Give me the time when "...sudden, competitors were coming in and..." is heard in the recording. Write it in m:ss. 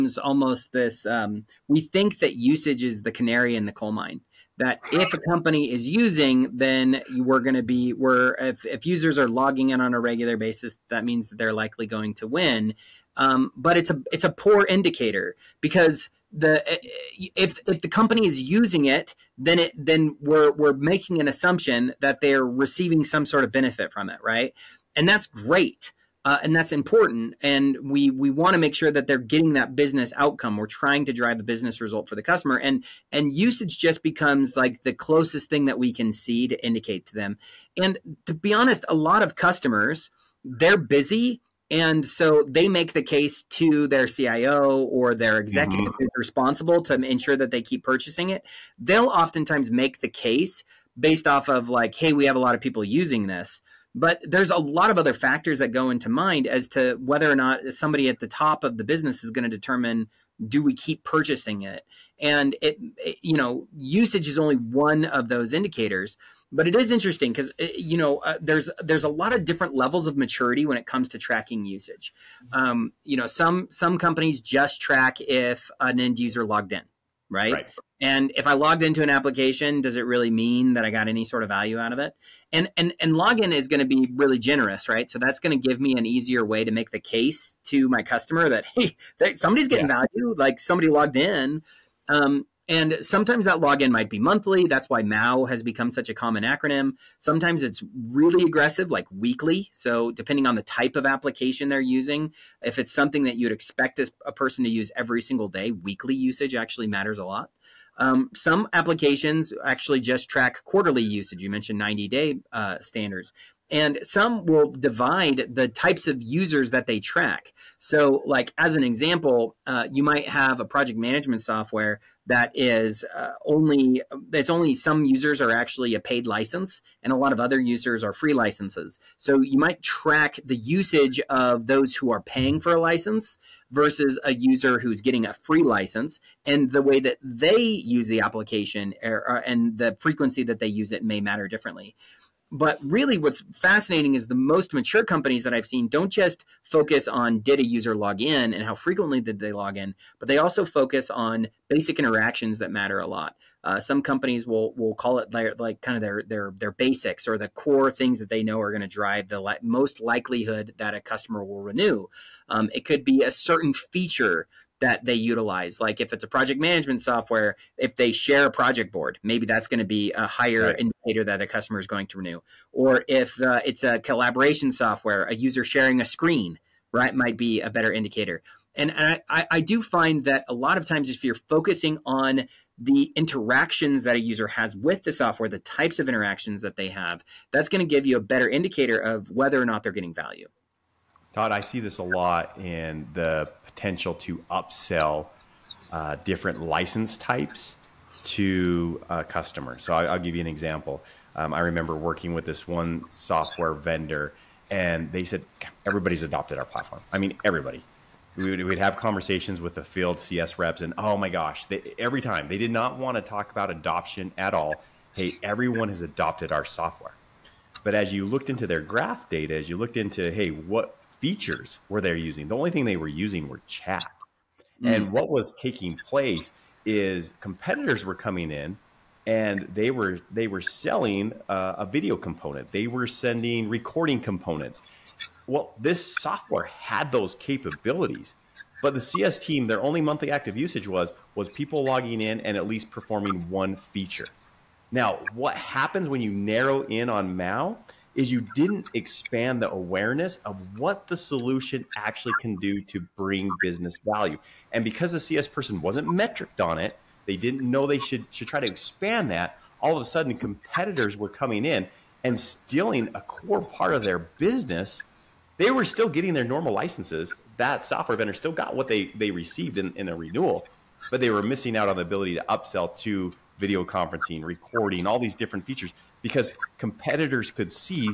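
4:20.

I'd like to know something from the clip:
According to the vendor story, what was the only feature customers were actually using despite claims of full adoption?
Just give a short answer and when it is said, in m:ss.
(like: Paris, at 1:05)
chat, at 3:43.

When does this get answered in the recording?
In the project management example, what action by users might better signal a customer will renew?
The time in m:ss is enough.
2:48.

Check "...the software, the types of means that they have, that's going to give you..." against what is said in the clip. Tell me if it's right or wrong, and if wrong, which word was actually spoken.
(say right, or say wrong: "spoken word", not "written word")
wrong: "interactions", not "means".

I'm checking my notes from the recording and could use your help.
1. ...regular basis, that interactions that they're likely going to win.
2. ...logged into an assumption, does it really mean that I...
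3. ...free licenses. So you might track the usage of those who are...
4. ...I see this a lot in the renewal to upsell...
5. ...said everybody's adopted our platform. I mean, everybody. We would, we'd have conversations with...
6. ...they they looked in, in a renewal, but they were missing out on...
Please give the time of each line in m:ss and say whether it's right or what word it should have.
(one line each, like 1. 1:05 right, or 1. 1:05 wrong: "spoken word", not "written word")
1. 0:09 wrong: "means", not "interactions"
2. 1:18 wrong: "application", not "assumption"
3. 2:08 right
4. 3:11 wrong: "potential", not "renewal"
5. 3:25 right
6. 4:28 wrong: "received", not "looked".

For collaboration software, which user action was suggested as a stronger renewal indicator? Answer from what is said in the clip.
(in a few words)
sharing a screen.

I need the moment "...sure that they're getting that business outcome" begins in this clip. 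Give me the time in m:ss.
0:28.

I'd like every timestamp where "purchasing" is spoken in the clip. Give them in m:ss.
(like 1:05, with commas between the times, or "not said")
0:47, 1:01.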